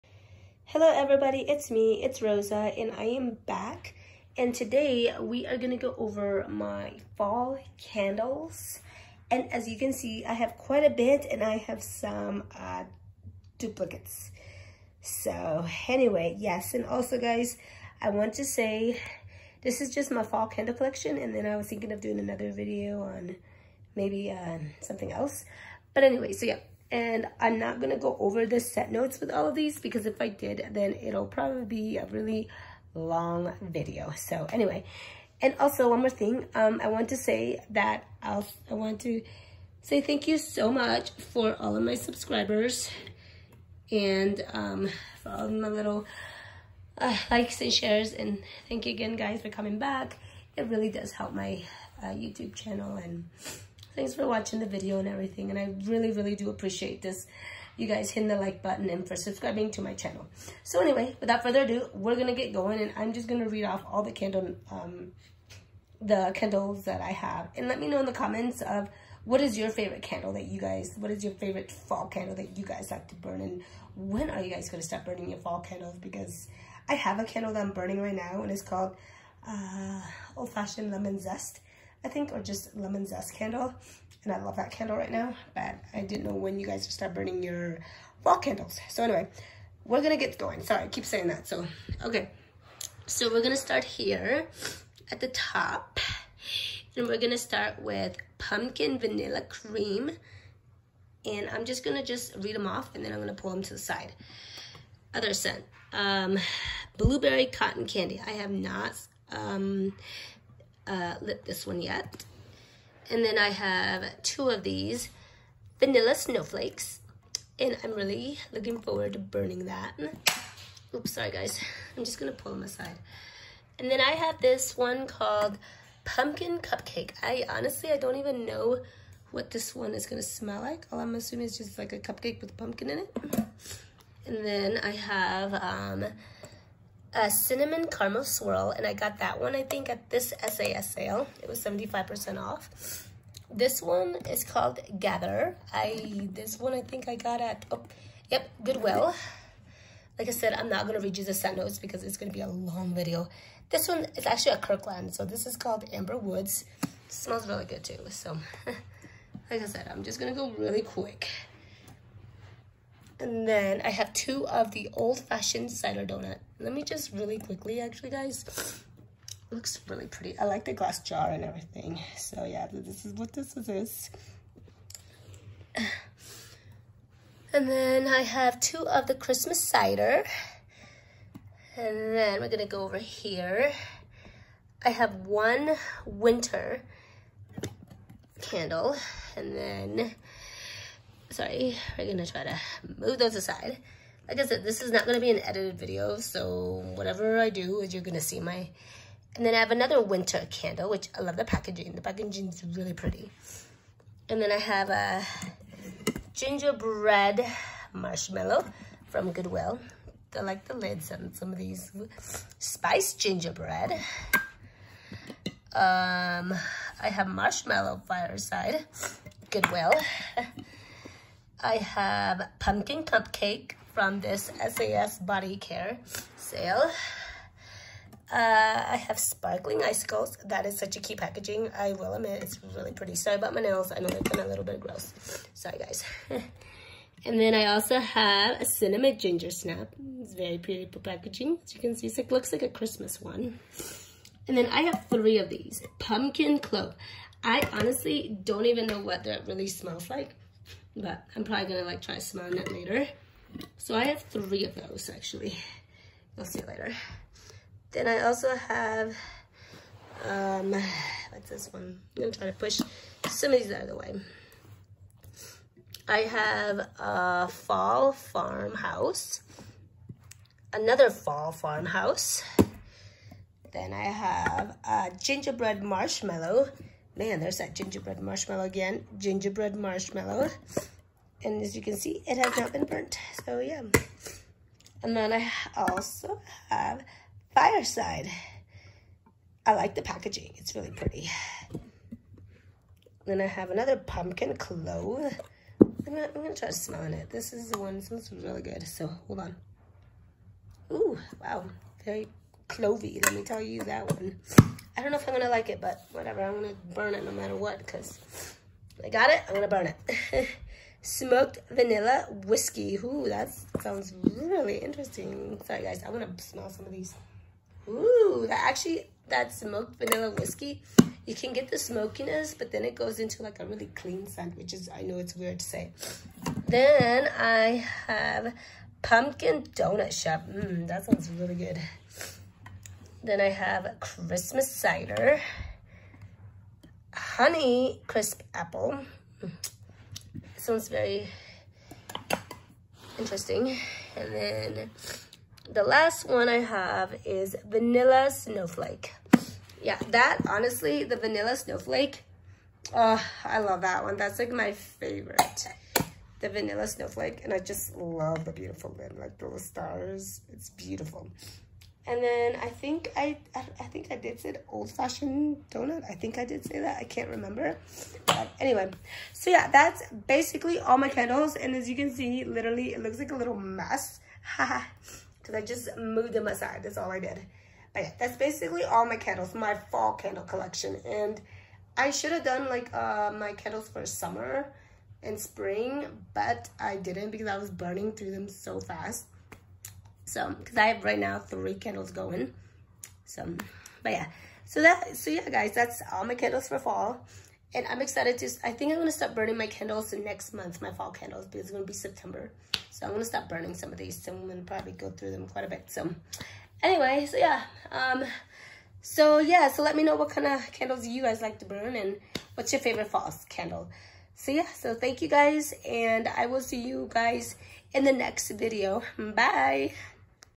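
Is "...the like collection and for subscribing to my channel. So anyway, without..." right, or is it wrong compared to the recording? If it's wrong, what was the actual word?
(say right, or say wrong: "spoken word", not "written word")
wrong: "button", not "collection".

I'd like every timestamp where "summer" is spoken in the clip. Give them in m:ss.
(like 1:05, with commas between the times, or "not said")
6:24.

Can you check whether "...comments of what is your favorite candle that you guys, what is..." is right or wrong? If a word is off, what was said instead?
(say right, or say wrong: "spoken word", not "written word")
right.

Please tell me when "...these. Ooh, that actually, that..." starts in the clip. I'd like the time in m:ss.
5:16.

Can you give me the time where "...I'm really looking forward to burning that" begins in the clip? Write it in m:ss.
1:57.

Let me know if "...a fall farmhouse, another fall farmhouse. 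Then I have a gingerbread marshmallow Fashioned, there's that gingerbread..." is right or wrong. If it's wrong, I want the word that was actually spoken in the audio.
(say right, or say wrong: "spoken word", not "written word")
wrong: "Man", not "Fashioned".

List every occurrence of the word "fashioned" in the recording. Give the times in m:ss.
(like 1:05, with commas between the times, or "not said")
1:20, 2:44, 6:04.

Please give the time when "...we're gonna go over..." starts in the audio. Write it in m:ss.
3:02.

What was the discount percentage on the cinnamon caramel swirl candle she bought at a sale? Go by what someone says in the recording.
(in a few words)
75%.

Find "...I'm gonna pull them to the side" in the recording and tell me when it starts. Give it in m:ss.
1:43.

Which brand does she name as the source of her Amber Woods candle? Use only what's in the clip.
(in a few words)
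Kirkland.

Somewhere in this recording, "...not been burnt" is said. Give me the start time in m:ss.
4:42.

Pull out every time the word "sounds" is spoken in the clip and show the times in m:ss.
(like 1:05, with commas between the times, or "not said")
5:13, 5:31.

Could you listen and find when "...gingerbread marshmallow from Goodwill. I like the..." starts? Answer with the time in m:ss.
3:26.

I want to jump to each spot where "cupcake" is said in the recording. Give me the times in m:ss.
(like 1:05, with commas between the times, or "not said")
2:06, 2:11, 3:43.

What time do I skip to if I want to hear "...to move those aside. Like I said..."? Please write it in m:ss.
3:12.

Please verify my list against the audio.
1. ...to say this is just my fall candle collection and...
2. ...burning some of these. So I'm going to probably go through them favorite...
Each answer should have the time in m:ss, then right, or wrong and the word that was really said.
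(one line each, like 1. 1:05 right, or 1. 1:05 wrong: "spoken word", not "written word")
1. 0:18 right
2. 6:43 wrong: "quite", not "favorite".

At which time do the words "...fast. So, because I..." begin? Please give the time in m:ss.
6:28.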